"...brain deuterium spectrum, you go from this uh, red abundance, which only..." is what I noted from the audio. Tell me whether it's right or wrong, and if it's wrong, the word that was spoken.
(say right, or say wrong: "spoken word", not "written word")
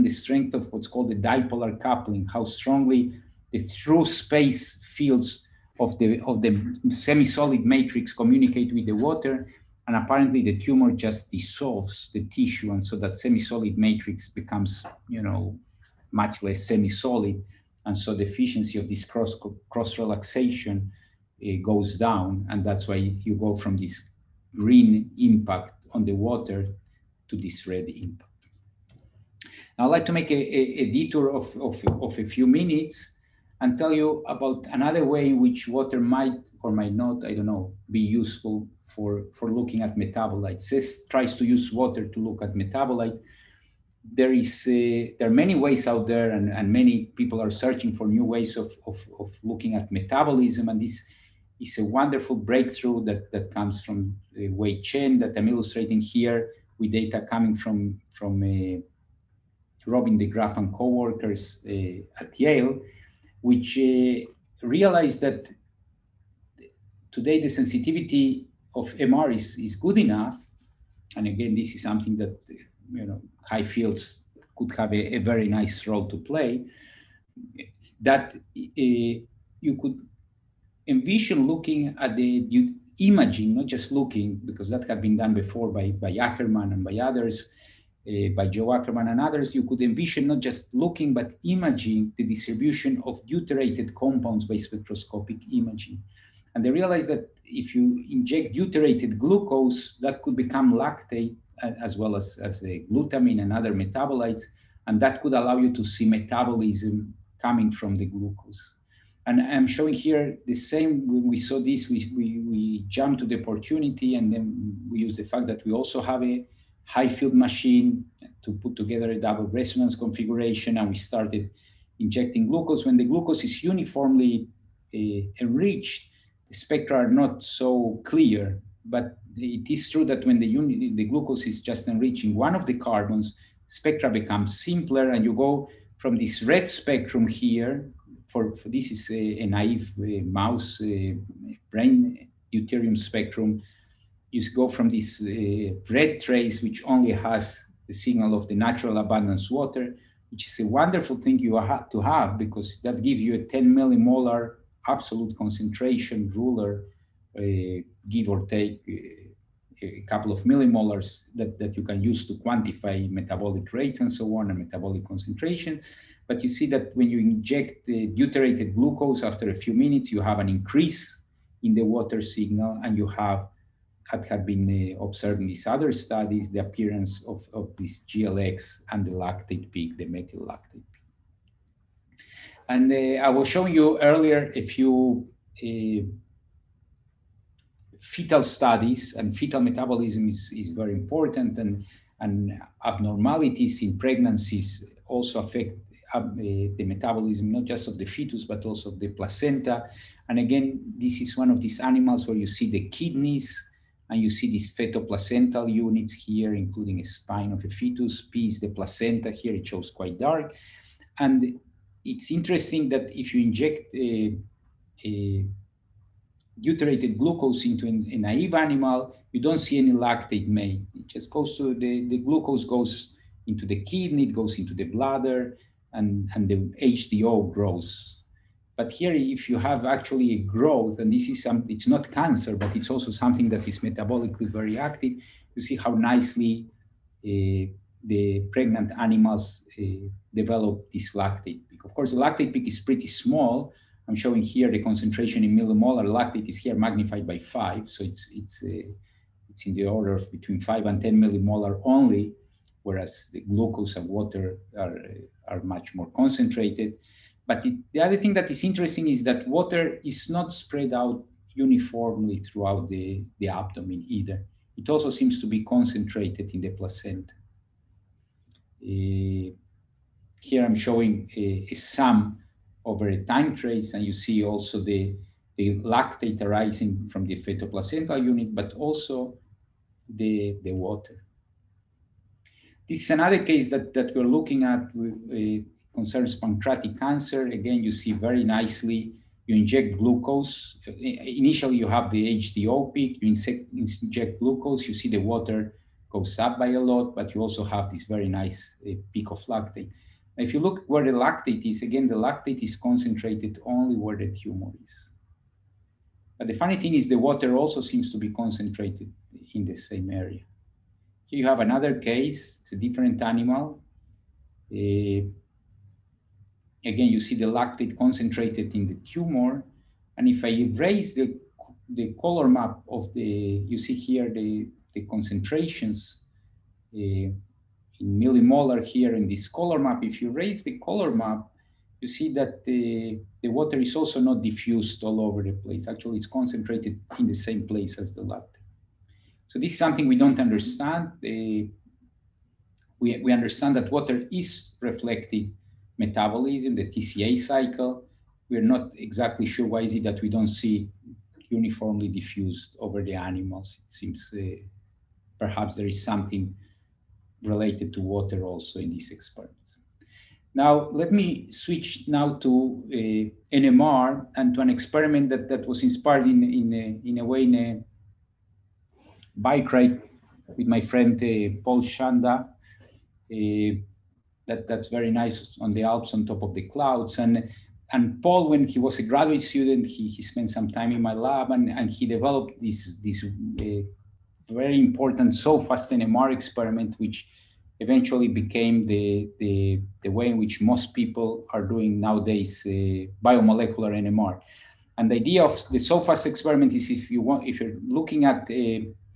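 wrong: "trace", not "abundance".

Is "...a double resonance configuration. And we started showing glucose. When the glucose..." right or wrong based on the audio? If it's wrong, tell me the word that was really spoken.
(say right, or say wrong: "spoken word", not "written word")
wrong: "injecting", not "showing".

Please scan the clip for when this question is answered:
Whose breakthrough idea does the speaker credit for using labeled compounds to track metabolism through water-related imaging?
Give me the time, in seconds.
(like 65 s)
54 s.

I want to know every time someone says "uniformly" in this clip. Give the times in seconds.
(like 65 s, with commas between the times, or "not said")
123 s, 261 s, 351 s.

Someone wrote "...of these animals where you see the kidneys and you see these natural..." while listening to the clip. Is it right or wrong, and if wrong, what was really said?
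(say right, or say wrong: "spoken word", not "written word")
wrong: "fetoplacental", not "natural".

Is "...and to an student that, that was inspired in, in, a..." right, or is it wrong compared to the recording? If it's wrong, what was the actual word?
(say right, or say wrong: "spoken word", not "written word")
wrong: "experiment", not "student".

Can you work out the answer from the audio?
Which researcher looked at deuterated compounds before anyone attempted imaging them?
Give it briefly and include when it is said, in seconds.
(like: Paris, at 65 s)
Joe Ackerman, at 88 s.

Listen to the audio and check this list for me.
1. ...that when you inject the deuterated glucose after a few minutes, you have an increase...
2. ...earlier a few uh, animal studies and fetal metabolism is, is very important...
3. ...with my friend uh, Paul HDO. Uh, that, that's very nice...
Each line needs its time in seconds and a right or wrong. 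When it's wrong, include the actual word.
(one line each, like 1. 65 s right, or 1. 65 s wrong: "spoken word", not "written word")
1. 166 s right
2. 183 s wrong: "fetal", not "animal"
3. 370 s wrong: "Schanda", not "HDO".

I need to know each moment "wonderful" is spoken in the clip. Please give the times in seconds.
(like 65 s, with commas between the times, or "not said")
51 s, 150 s.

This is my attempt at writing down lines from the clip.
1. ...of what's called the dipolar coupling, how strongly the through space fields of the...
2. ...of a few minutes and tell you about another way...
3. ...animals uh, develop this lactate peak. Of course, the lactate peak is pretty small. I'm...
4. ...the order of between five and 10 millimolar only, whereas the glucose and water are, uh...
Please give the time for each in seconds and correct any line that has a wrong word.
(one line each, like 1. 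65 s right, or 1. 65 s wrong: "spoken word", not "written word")
1. 0 s right
2. 32 s right
3. 238 s right
4. 249 s right.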